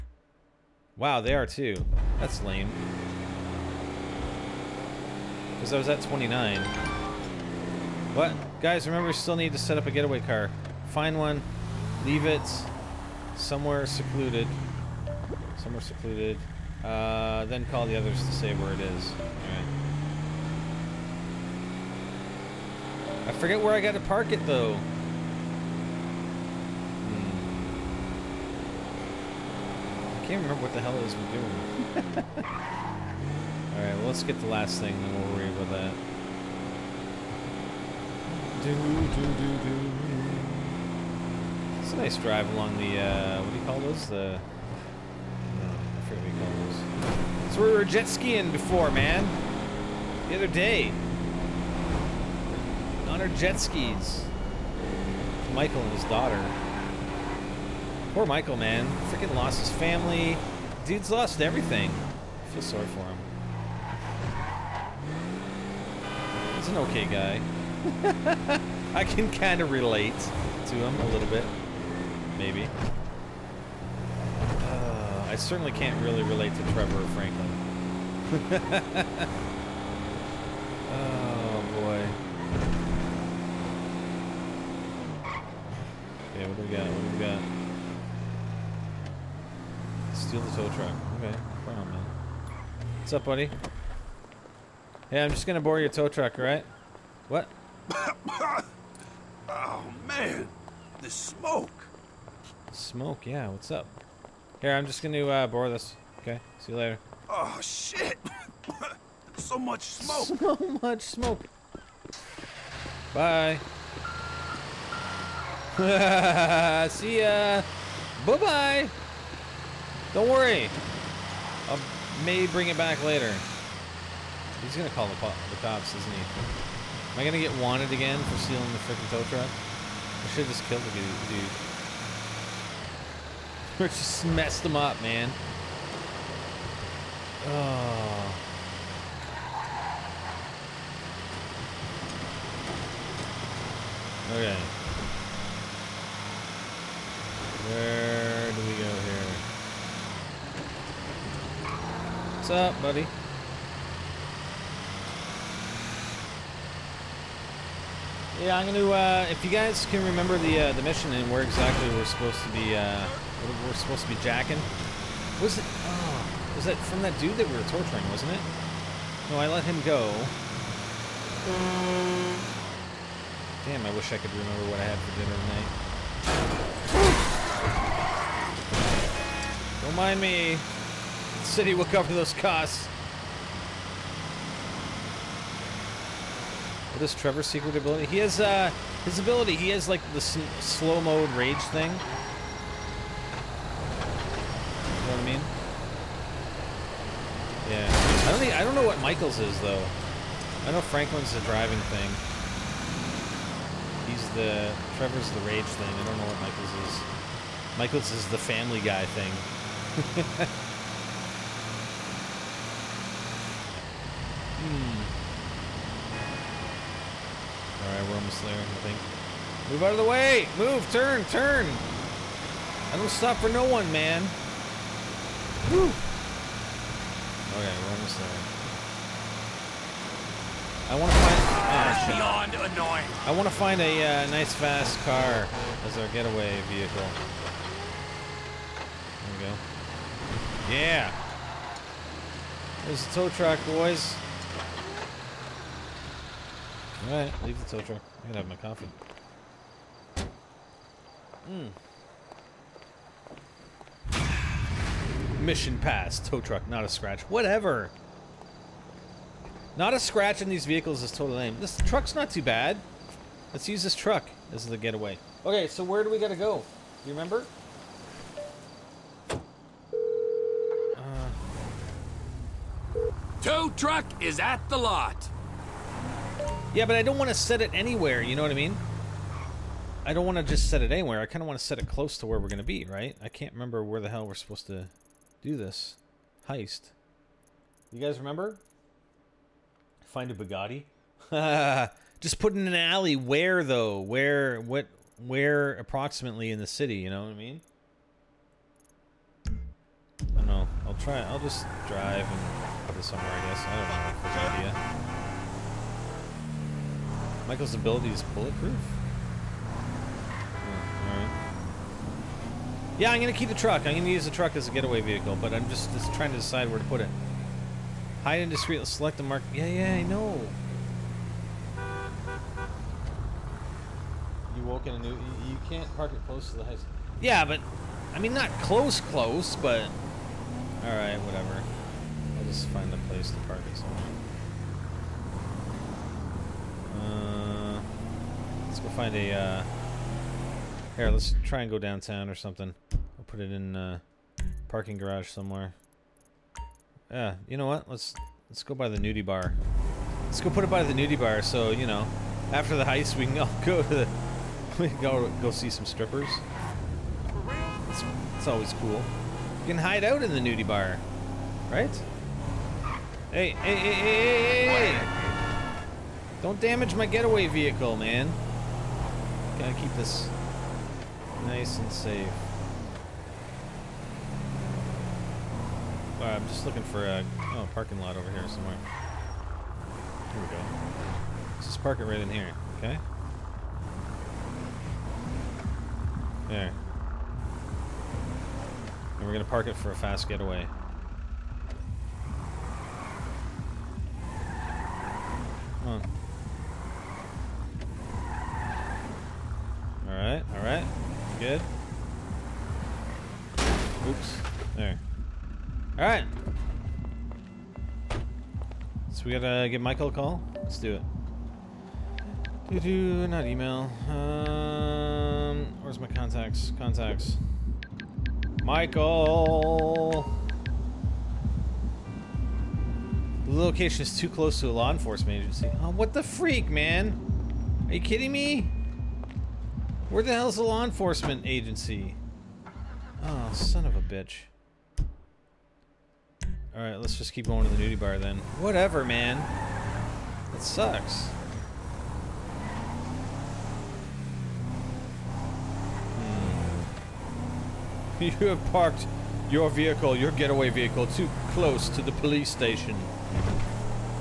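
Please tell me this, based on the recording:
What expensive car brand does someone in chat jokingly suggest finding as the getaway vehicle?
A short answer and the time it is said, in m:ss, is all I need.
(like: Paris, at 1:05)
Bugatti, at 4:50.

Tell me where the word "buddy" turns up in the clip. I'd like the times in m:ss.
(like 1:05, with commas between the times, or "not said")
1:33, 2:32.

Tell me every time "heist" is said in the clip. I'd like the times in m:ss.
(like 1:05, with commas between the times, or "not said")
4:46, 5:52.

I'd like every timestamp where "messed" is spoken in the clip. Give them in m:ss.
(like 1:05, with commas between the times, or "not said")
2:14.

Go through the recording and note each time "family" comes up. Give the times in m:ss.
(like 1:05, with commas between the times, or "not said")
0:59, 3:28.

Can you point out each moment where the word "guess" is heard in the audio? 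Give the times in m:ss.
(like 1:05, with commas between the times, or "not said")
5:03.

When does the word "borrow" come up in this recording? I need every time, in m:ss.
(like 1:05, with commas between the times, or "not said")
1:35, 1:45.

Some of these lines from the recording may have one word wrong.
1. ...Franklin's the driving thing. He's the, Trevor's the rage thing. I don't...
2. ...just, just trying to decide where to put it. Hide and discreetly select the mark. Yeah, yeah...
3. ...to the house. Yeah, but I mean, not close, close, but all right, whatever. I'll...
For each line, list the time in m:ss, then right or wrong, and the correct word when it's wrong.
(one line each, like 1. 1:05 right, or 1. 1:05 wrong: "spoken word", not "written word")
1. 3:20 right
2. 5:15 right
3. 5:26 right.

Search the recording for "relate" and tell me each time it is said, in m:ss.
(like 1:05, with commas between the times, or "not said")
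1:09, 1:16.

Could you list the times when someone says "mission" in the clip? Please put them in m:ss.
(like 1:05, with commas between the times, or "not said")
2:40, 4:15.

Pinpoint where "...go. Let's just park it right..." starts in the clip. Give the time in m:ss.
6:20.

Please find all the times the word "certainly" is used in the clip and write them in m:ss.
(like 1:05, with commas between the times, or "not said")
1:15.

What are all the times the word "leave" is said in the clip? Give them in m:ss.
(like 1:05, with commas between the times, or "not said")
0:12, 4:07.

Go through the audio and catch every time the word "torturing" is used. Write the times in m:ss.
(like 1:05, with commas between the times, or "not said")
2:47.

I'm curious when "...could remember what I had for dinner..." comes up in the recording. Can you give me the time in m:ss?
2:54.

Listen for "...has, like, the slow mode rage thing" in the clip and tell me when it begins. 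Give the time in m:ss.
3:09.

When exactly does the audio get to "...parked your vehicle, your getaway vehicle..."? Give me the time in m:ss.
7:28.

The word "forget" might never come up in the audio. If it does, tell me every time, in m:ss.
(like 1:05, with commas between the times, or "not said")
0:23, 0:46.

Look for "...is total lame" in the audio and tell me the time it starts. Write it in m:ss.
4:21.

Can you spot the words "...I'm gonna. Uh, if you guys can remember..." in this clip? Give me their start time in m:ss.
2:38.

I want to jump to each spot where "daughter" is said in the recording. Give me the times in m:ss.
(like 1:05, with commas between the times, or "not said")
0:56.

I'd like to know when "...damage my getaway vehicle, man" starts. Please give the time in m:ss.
6:06.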